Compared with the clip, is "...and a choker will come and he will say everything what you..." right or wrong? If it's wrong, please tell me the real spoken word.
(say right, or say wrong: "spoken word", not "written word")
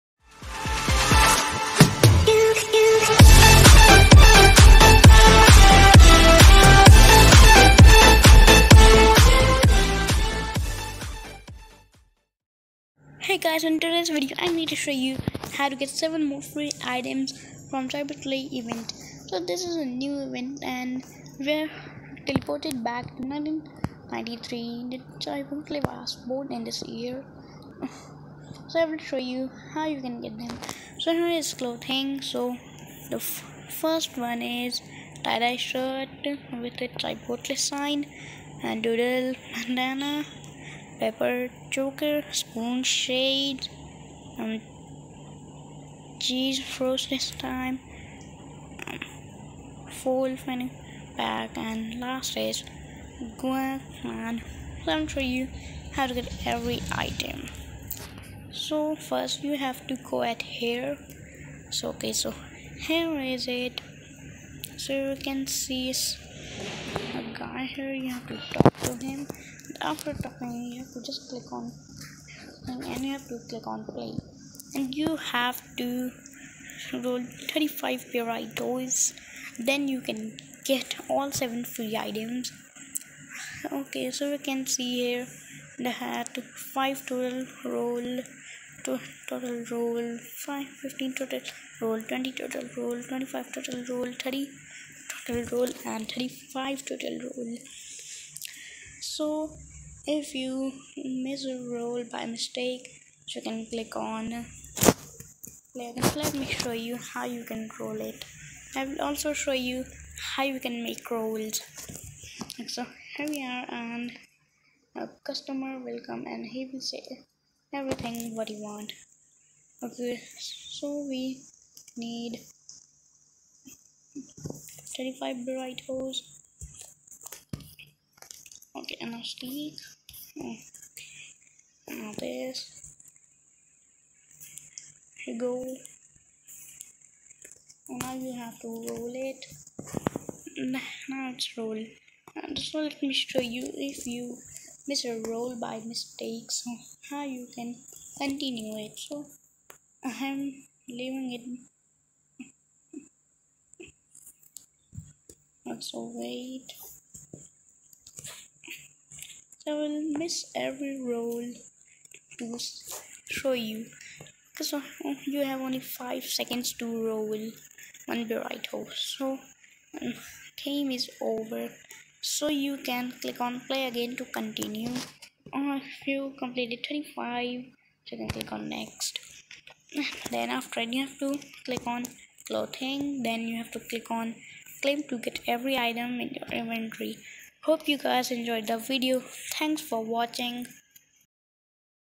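wrong: "customer", not "choker".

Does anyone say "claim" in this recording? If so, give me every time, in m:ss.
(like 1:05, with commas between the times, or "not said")
3:04.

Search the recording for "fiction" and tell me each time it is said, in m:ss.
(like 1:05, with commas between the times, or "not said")
not said.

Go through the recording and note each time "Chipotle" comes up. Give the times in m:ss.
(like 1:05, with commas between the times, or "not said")
0:17, 0:25, 0:36.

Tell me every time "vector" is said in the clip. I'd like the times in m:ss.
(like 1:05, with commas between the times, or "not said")
not said.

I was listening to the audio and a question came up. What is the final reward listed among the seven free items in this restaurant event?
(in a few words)
guac.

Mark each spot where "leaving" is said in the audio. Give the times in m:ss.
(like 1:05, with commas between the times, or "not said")
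2:30.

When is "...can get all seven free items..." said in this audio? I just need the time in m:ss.
1:20.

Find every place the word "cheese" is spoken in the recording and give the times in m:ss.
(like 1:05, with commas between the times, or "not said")
0:46.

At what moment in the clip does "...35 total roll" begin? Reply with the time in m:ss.
1:36.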